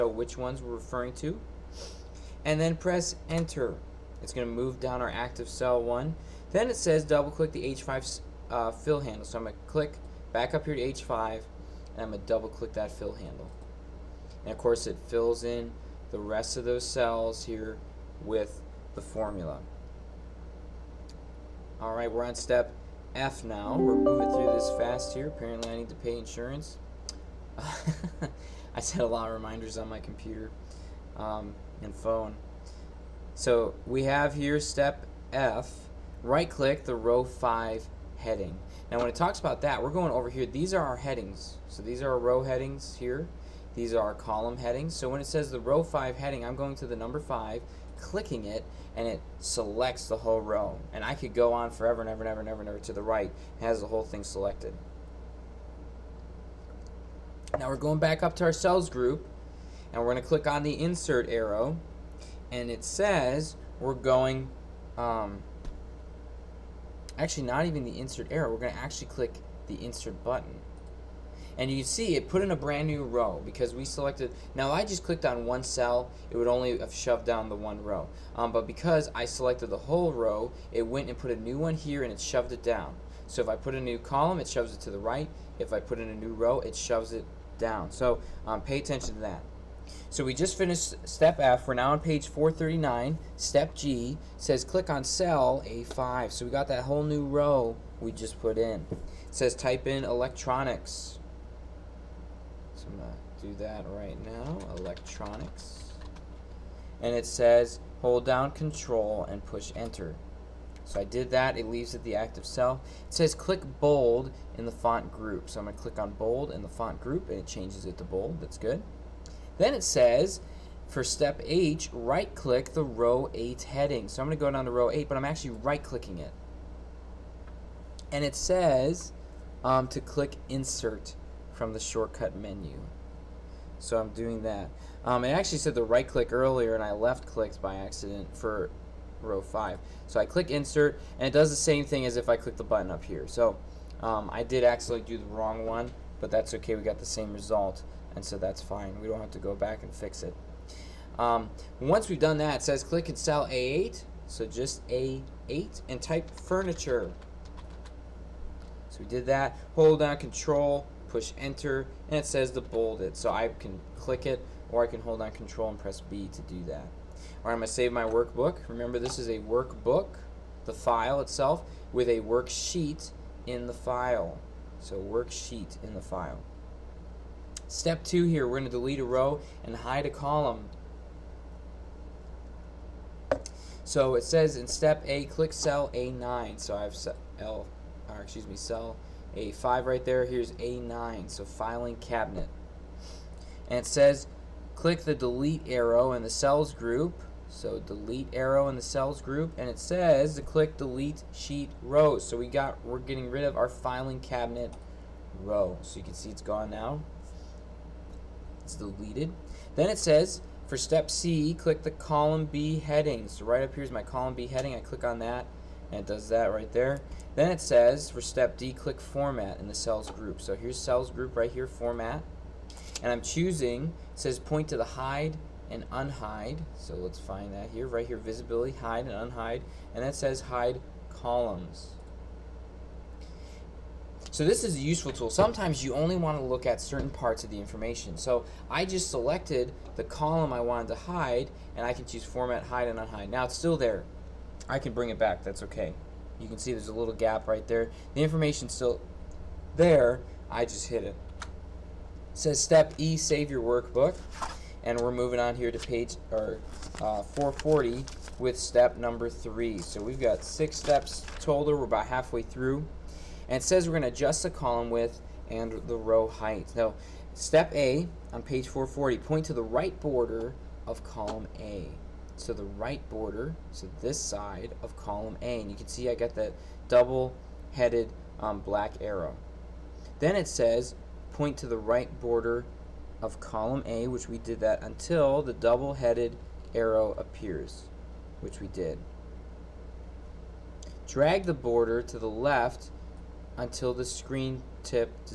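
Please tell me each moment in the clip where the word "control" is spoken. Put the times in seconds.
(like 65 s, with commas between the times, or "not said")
108 s, 160 s, 165 s.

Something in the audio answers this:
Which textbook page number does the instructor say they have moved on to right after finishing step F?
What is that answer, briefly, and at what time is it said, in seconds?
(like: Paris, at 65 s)
439, at 92 s.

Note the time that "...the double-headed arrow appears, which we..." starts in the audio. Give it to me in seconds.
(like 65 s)
285 s.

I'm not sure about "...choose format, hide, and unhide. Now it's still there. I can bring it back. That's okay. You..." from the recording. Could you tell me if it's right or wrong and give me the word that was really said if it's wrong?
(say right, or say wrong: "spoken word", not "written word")
right.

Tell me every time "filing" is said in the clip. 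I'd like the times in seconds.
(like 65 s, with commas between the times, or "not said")
191 s, 203 s.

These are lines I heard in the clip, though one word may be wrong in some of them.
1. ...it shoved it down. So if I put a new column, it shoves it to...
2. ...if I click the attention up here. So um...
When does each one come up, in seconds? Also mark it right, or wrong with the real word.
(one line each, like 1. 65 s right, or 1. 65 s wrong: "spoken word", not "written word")
1. 82 s right
2. 142 s wrong: "button", not "attention".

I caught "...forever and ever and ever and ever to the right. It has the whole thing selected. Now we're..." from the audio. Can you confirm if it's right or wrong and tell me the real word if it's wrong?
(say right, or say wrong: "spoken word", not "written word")
right.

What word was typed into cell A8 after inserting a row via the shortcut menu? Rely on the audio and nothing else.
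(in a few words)
Furniture.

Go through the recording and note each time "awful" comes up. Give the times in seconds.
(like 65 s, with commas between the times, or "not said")
not said.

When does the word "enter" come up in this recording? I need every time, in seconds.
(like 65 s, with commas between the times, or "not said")
3 s, 109 s, 161 s.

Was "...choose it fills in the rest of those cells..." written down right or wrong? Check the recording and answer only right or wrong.
wrong.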